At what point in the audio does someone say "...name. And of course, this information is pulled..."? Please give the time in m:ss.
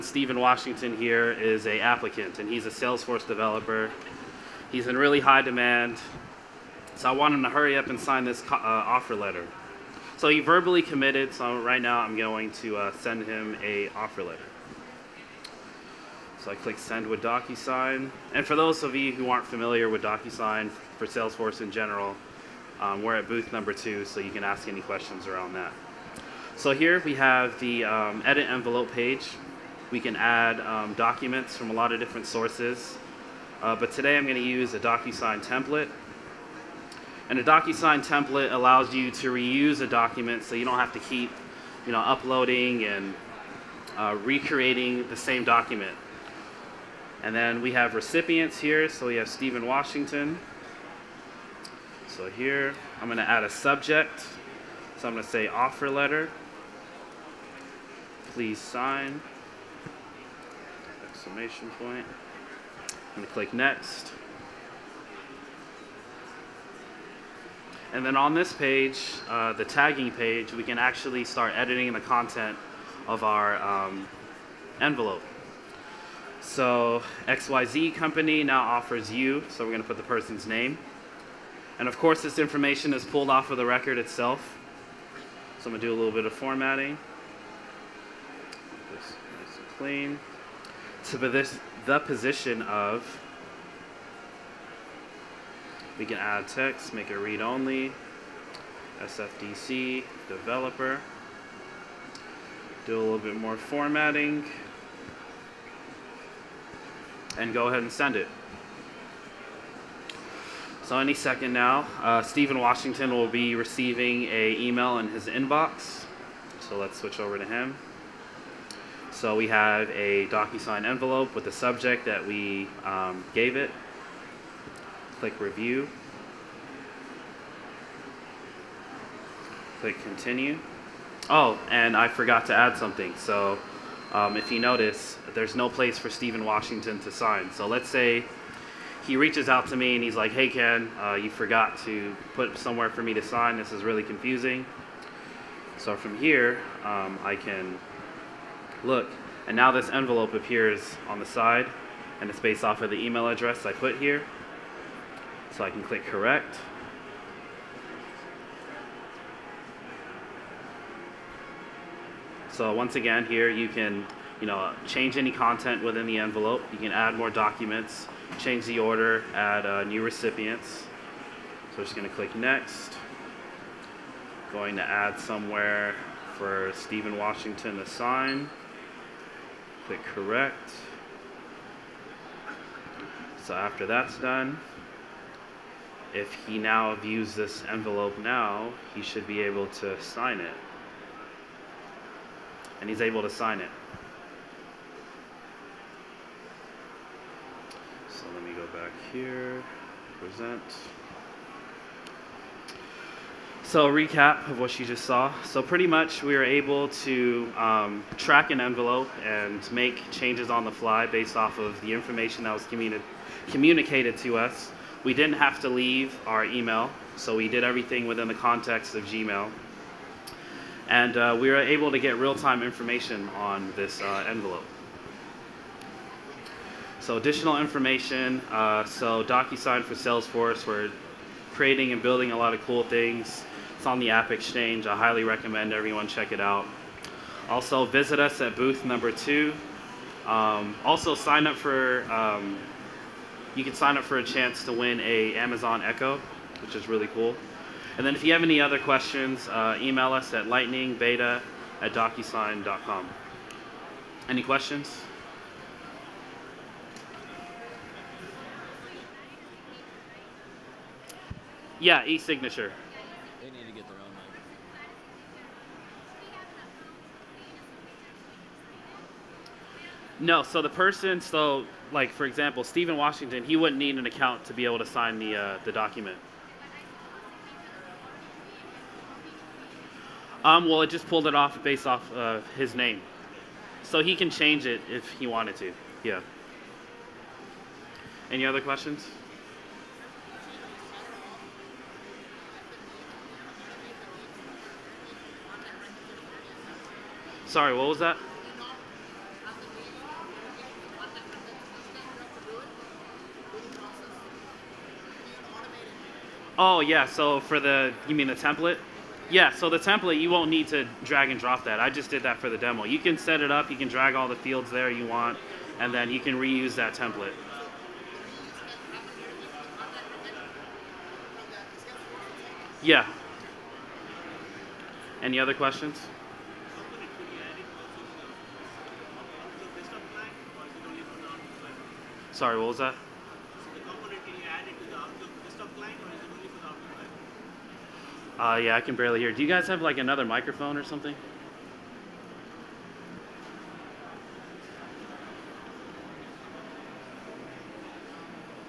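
1:20.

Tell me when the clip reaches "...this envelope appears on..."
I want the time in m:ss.
2:29.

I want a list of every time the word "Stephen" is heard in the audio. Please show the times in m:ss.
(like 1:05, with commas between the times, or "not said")
0:00, 0:49, 1:52, 2:16, 2:56, 4:32.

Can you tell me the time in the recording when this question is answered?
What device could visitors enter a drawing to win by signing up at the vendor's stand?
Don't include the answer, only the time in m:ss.
4:05.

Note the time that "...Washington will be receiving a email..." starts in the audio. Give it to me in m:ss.
1:52.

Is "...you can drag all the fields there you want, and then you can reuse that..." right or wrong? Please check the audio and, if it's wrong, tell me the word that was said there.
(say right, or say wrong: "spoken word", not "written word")
right.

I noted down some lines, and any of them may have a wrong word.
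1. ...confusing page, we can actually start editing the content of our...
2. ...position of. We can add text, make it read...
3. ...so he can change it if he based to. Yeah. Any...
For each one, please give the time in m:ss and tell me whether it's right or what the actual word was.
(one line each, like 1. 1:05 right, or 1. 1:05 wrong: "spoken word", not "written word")
1. 1:09 wrong: "tagging", not "confusing"
2. 1:31 right
3. 4:43 wrong: "wanted", not "based".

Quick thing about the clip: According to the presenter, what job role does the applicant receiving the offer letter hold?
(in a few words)
Salesforce developer.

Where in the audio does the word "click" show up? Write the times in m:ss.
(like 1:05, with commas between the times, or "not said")
0:16, 1:03, 2:05, 2:09, 2:35, 2:52, 2:59.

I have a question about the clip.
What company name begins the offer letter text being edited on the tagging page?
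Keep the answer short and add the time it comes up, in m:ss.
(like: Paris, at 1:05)
XYZ company, at 1:17.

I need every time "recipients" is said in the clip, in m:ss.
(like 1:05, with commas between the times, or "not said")
0:47, 2:50.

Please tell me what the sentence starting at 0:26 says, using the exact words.
So here we have the um, edit envelope page.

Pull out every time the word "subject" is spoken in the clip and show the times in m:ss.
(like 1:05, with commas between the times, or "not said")
0:53, 2:01.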